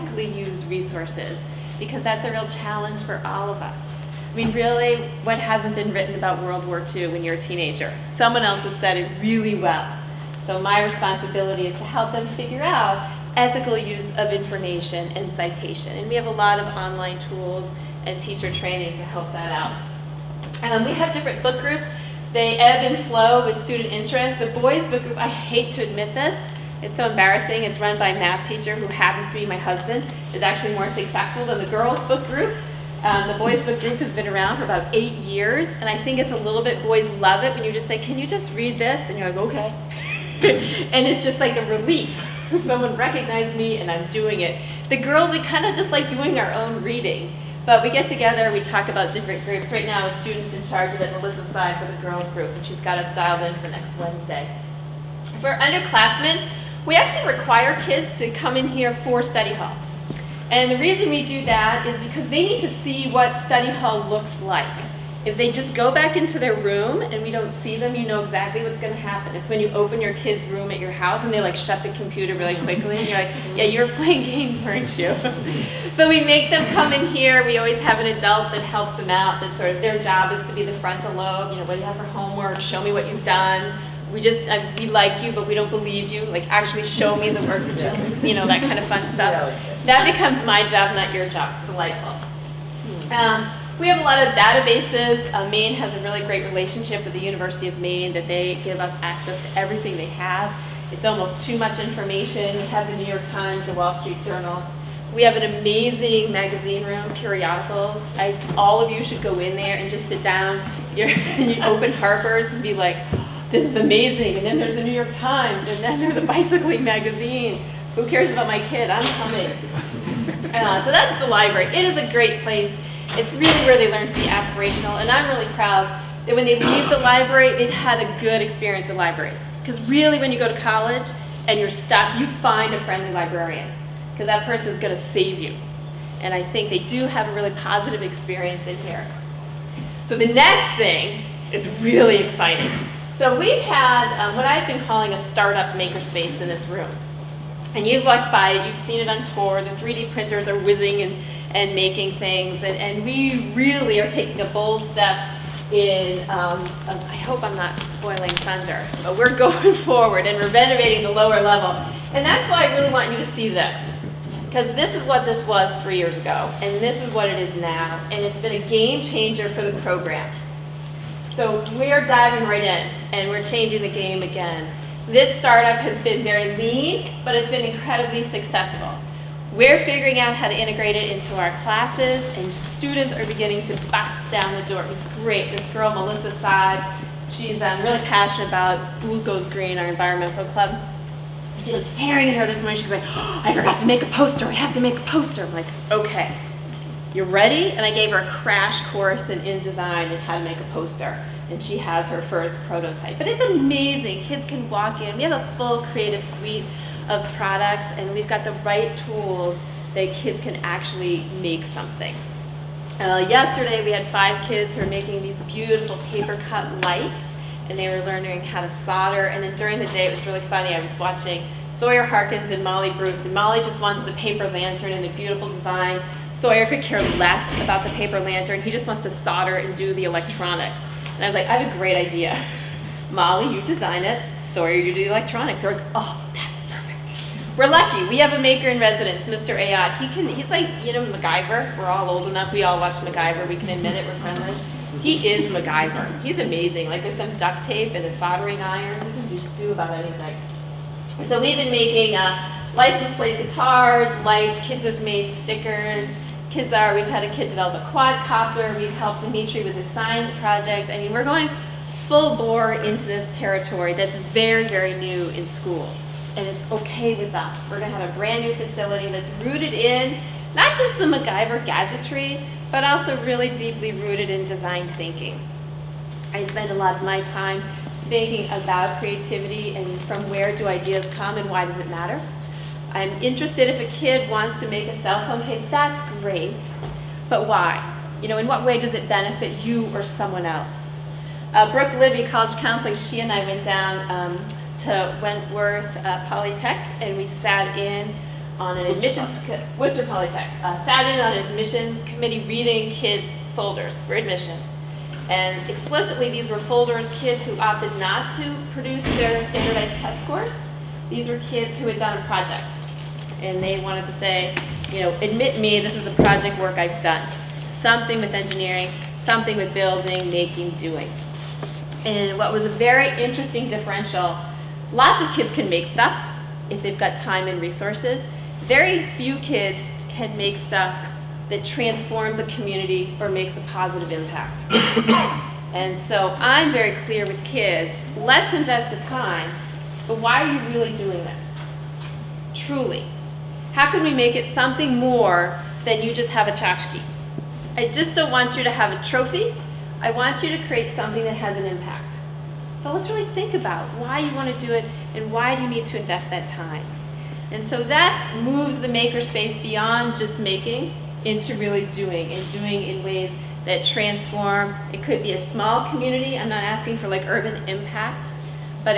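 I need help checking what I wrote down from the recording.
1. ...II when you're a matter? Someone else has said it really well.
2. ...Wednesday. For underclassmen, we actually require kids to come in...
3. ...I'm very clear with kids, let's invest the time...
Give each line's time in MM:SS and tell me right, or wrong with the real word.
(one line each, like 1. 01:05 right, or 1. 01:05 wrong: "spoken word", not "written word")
1. 00:06 wrong: "teenager", not "matter"
2. 00:53 right
3. 05:36 right.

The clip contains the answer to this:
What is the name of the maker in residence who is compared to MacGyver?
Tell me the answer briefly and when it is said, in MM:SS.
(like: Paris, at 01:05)
Mr. Ayad, at 03:59.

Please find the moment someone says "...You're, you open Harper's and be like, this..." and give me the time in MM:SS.
01:50.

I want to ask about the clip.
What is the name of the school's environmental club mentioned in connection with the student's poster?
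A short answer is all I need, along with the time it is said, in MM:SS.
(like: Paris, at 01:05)
Goes Green, at 03:09.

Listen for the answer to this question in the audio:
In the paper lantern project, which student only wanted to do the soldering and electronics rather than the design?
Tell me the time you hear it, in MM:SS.
03:41.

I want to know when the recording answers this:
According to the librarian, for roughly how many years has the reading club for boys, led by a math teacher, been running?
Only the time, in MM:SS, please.
00:34.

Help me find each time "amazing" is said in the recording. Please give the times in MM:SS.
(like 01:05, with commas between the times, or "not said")
01:45, 01:53, 03:23, 04:06.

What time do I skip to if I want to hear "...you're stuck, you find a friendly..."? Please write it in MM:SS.
02:11.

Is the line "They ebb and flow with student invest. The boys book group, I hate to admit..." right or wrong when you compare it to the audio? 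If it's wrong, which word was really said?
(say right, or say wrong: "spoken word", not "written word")
wrong: "interest", not "invest".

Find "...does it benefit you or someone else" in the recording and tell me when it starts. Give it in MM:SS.
04:48.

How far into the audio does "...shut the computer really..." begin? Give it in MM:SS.
01:11.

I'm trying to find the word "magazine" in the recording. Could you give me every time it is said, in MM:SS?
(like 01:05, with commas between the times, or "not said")
01:46, 01:56.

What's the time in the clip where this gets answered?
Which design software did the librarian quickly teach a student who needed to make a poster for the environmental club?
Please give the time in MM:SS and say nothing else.
03:19.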